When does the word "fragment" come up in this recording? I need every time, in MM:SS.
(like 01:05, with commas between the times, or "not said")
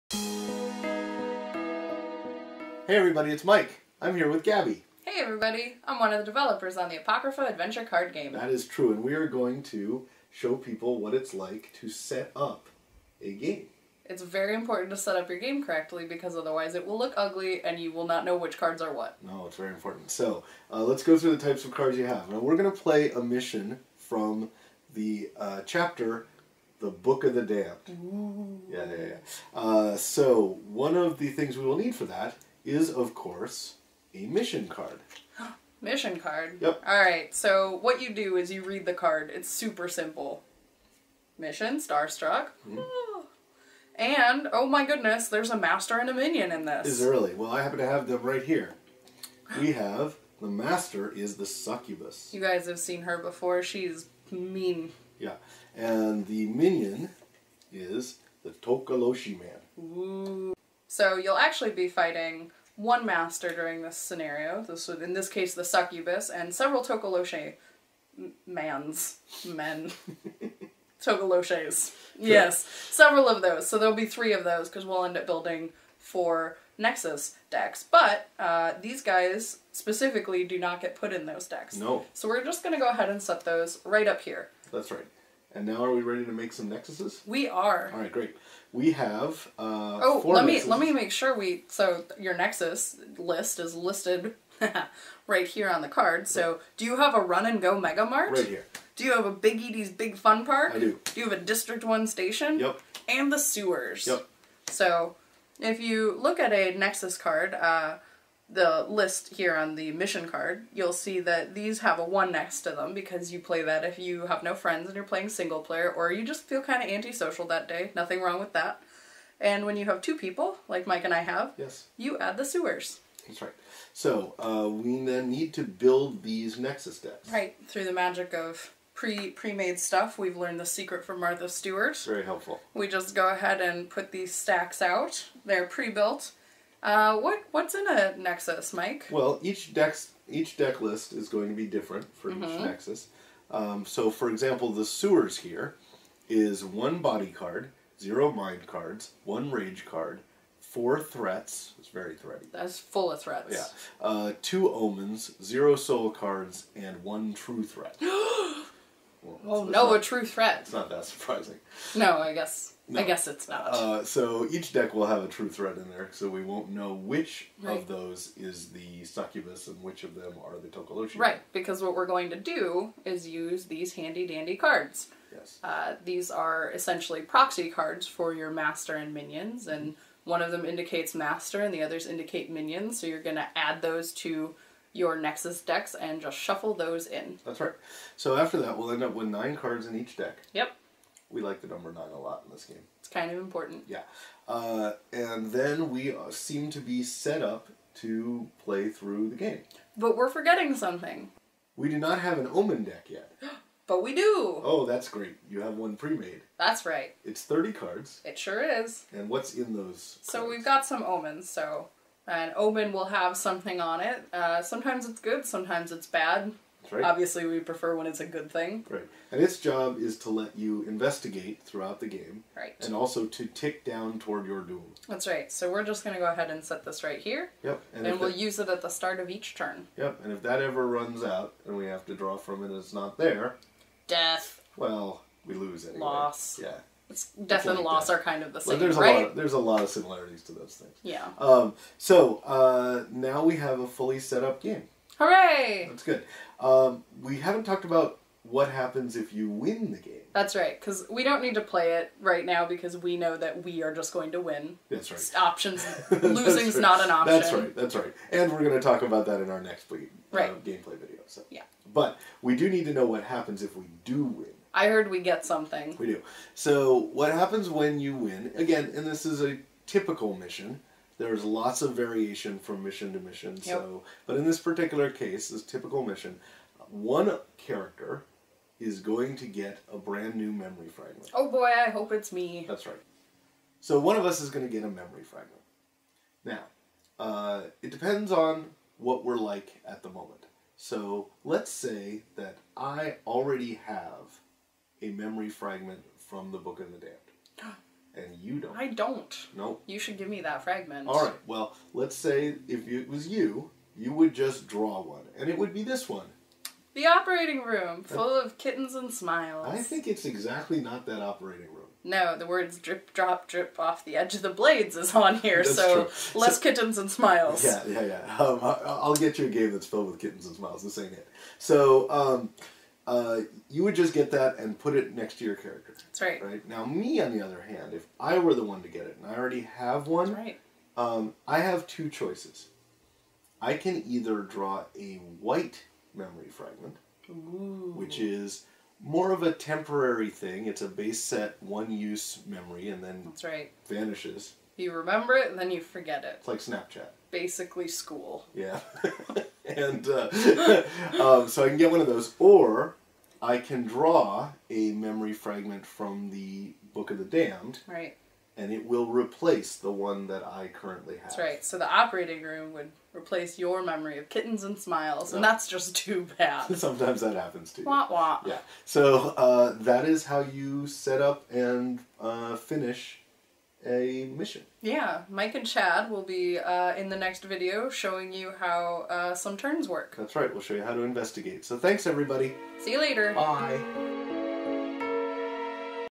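04:40, 04:45, 04:55, 05:00, 05:36, 05:55.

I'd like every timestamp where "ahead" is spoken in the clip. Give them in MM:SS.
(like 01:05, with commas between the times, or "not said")
01:22, 02:13, 03:46.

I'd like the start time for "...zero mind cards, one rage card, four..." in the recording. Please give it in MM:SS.
02:27.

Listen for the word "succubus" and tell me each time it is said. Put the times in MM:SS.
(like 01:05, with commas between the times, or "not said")
00:51, 01:05, 02:49.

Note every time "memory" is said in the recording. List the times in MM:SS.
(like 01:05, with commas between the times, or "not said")
04:40, 04:44, 04:55, 05:36, 05:42, 05:54, 06:03.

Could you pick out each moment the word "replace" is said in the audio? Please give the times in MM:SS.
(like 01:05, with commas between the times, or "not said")
05:59, 06:03.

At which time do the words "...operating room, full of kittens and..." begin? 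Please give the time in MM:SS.
05:07.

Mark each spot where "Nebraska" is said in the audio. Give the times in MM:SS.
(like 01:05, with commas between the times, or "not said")
not said.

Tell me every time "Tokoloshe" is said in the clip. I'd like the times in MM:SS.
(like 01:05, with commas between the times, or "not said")
00:58, 01:06, 02:50.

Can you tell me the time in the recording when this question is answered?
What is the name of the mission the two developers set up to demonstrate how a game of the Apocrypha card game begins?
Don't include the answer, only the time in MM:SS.
00:41.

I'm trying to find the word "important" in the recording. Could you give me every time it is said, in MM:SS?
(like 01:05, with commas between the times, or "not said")
00:14, 00:19, 03:13.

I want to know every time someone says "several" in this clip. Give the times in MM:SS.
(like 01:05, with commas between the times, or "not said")
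01:06, 01:12.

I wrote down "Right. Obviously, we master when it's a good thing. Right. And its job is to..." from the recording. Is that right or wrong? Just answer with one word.
wrong.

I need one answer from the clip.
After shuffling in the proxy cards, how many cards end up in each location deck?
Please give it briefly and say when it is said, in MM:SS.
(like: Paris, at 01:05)
9, at 03:09.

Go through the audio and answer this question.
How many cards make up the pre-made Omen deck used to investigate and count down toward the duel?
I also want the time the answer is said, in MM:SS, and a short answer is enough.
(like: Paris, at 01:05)
30, at 03:27.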